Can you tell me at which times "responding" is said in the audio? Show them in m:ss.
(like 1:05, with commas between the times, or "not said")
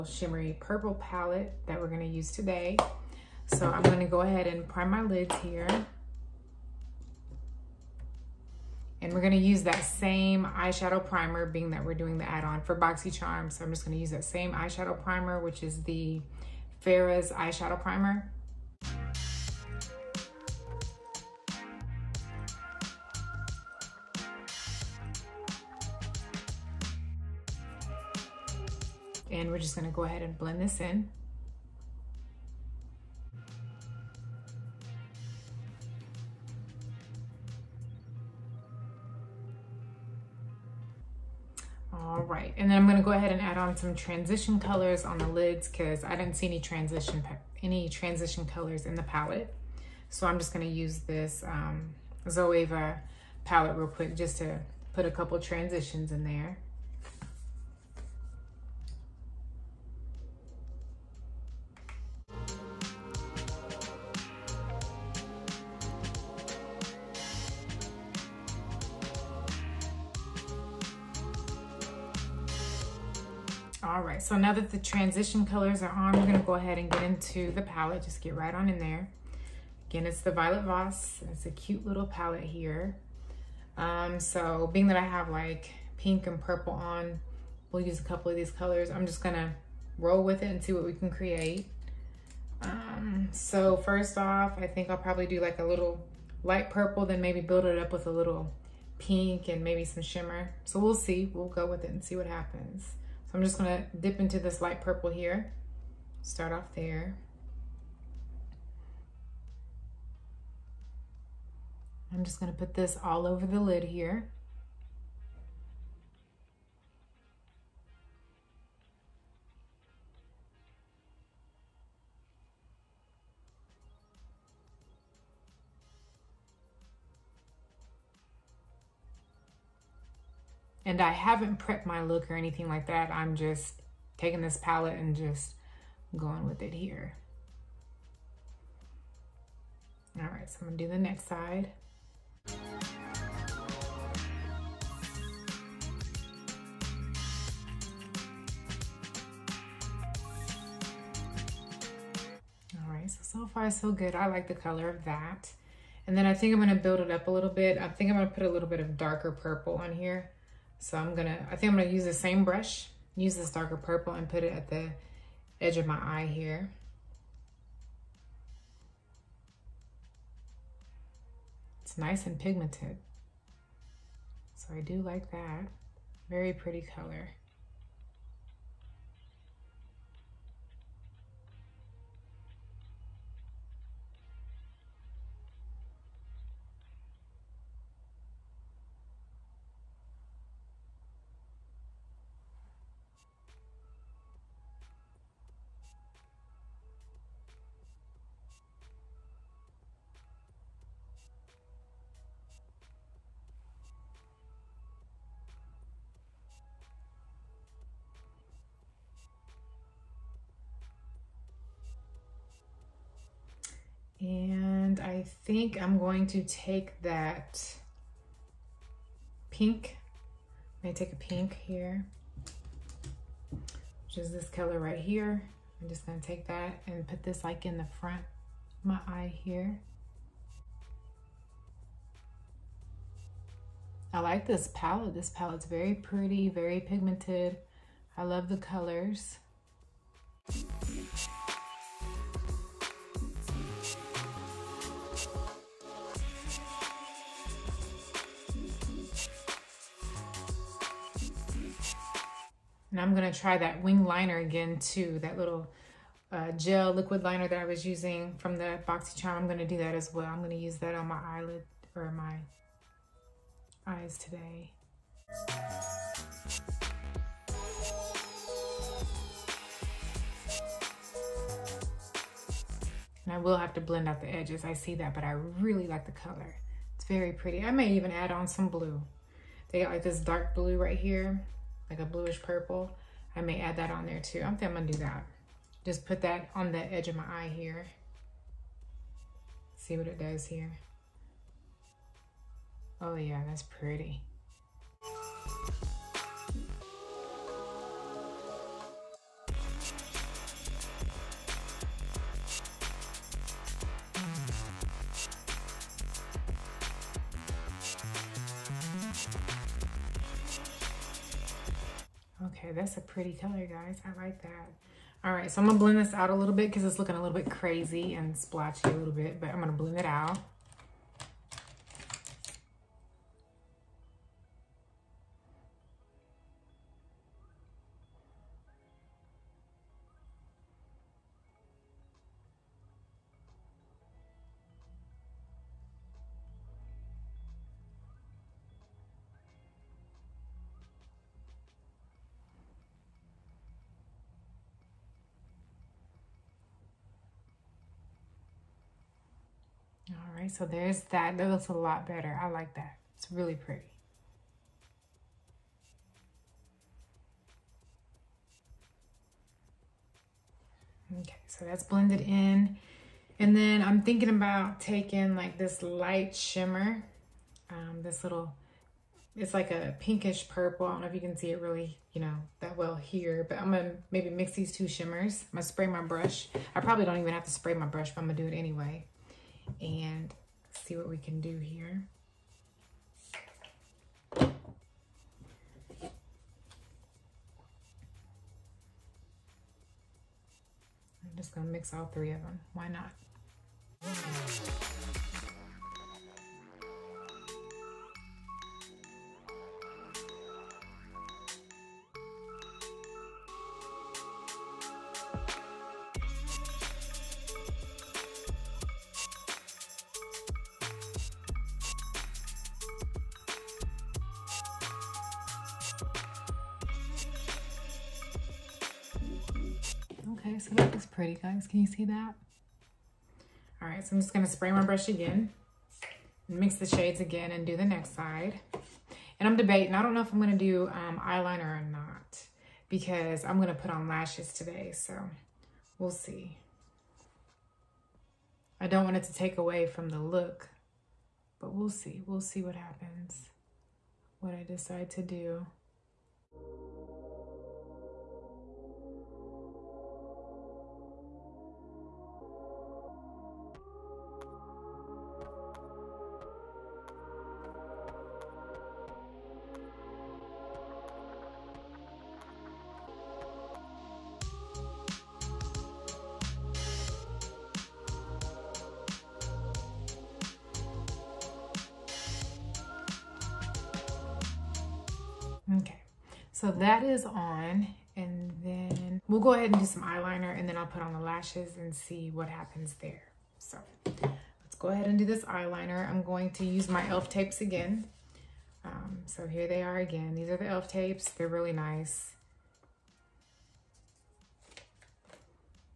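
not said.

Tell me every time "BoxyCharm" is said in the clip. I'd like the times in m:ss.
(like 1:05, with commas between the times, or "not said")
0:12, 4:18.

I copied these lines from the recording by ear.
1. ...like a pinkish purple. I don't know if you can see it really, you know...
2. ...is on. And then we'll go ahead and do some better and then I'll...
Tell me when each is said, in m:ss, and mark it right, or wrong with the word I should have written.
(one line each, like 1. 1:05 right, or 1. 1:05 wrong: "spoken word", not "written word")
1. 6:09 right
2. 7:57 wrong: "eyeliner", not "better".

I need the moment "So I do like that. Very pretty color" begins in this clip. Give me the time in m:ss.
2:54.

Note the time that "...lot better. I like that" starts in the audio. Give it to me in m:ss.
5:51.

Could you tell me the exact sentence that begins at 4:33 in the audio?
And I will have to blend out the edges.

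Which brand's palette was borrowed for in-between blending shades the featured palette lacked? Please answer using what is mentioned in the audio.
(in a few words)
Zoeva.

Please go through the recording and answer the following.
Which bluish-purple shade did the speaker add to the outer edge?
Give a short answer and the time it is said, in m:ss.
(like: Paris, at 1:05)
Dark blue, at 4:40.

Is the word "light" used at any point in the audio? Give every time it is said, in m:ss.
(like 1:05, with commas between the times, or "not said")
1:36, 1:44, 6:05.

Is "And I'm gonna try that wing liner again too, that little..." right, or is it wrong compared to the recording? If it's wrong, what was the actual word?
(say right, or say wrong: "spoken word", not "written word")
right.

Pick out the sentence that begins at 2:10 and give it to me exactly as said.
And I haven't prepped my look or anything like that.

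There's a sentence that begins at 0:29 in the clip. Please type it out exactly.
And we're just gonna go ahead and blend this in.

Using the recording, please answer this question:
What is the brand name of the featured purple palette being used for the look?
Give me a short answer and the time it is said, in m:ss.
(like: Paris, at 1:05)
Violet Voss, at 1:20.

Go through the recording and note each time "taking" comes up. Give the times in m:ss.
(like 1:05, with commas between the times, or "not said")
2:14, 6:04.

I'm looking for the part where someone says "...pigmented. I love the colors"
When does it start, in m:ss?
3:56.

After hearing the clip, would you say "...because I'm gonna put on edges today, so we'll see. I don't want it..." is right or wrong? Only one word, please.
wrong.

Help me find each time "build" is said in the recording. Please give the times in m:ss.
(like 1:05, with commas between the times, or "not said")
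1:37, 2:36.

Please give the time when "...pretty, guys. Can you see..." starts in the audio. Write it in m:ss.
7:01.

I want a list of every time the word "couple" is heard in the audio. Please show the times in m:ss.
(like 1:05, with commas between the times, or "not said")
0:55, 1:28.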